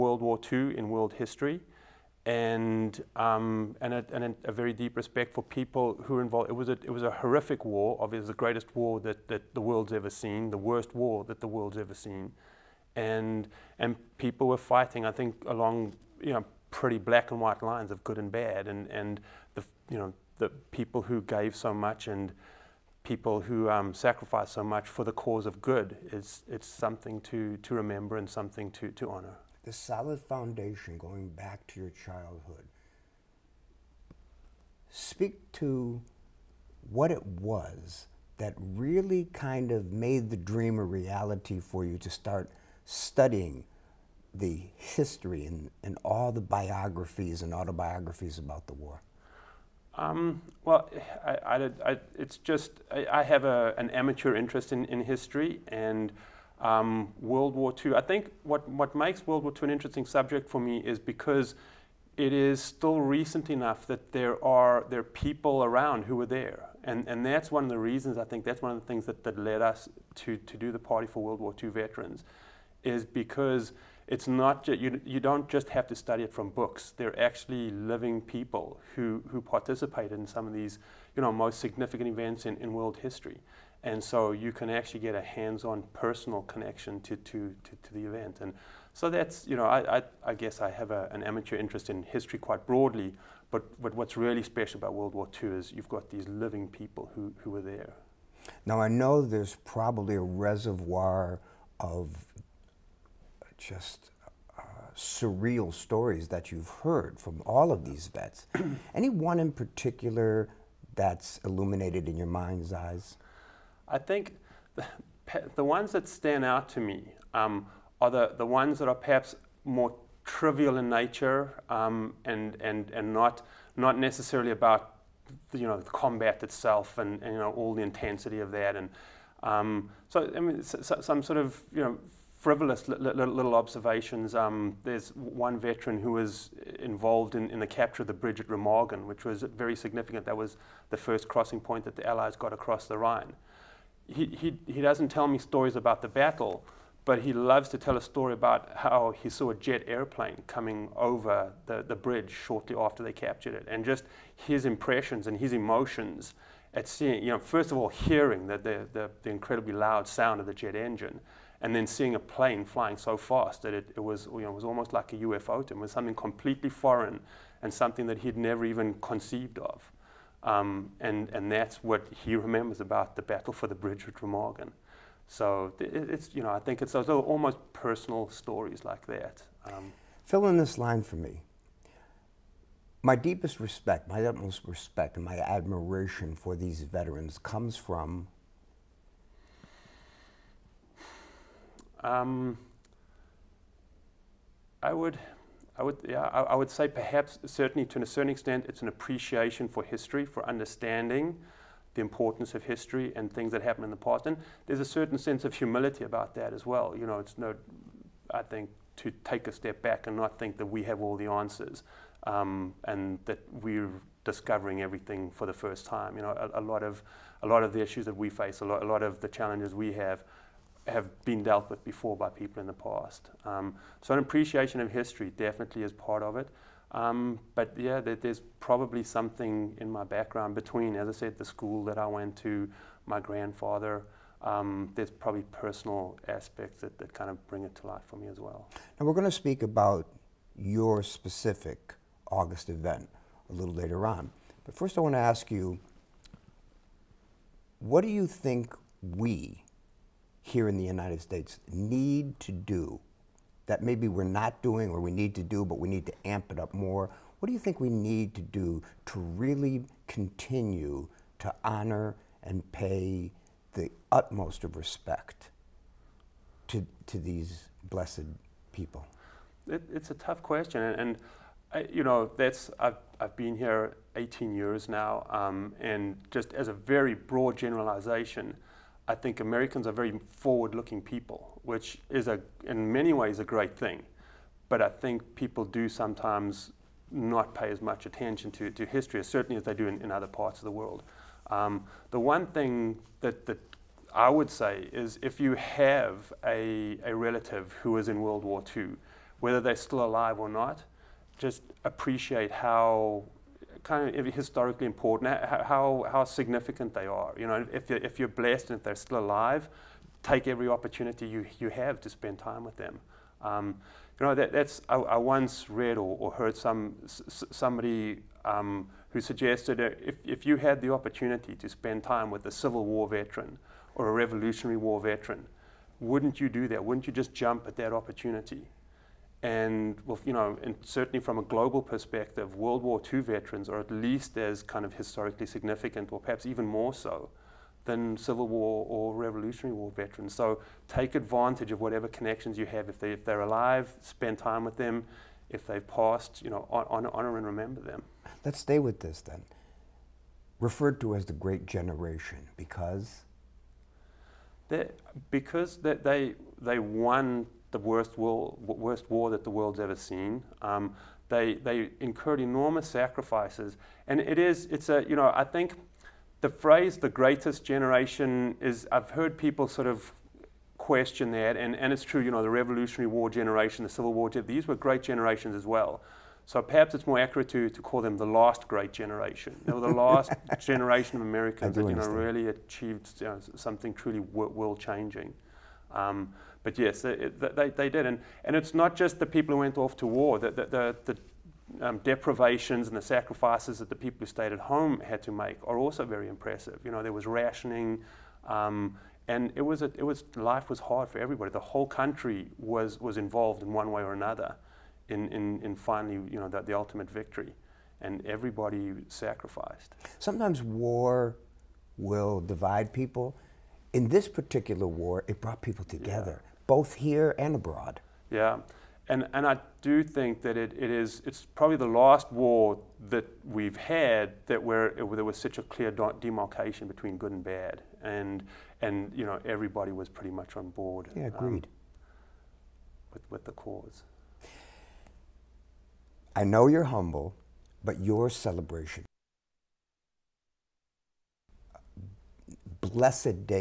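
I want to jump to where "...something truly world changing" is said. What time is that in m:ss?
6:23.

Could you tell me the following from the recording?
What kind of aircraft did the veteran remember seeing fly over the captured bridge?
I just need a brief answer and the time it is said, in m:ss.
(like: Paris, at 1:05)
Jet airplane, at 2:29.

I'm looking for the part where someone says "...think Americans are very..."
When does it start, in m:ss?
4:39.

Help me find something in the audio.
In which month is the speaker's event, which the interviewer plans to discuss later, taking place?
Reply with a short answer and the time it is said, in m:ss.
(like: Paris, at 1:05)
August, at 4:02.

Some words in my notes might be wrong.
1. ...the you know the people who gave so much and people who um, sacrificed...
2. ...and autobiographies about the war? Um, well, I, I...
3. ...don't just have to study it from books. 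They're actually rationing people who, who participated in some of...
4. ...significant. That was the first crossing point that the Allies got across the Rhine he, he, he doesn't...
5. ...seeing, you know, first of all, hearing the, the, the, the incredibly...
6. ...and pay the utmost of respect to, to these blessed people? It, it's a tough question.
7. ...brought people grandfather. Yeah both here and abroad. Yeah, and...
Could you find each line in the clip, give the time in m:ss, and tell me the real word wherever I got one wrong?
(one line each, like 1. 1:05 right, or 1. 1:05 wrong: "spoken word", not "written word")
1. 0:19 right
2. 0:47 right
3. 1:15 wrong: "living", not "rationing"
4. 2:19 right
5. 2:36 right
6. 4:22 right
7. 6:55 wrong: "together", not "grandfather".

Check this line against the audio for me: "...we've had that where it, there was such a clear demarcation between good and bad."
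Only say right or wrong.
right.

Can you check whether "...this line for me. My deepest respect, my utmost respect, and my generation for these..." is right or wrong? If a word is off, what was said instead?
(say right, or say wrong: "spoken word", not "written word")
wrong: "admiration", not "generation".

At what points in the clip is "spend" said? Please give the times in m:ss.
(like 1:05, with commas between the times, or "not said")
5:12, 5:21, 5:44.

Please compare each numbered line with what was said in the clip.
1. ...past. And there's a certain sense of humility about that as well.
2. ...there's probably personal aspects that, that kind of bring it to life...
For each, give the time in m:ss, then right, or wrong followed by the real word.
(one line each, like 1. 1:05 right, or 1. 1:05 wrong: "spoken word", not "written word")
1. 3:23 right
2. 3:54 right.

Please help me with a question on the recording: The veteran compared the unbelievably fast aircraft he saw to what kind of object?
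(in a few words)
UFO.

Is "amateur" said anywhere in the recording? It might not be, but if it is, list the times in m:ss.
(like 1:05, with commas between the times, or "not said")
0:53, 1:31.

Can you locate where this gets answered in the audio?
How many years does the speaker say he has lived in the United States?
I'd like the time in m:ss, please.
4:34.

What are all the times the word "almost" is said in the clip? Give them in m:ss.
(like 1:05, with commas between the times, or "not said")
2:44, 2:57.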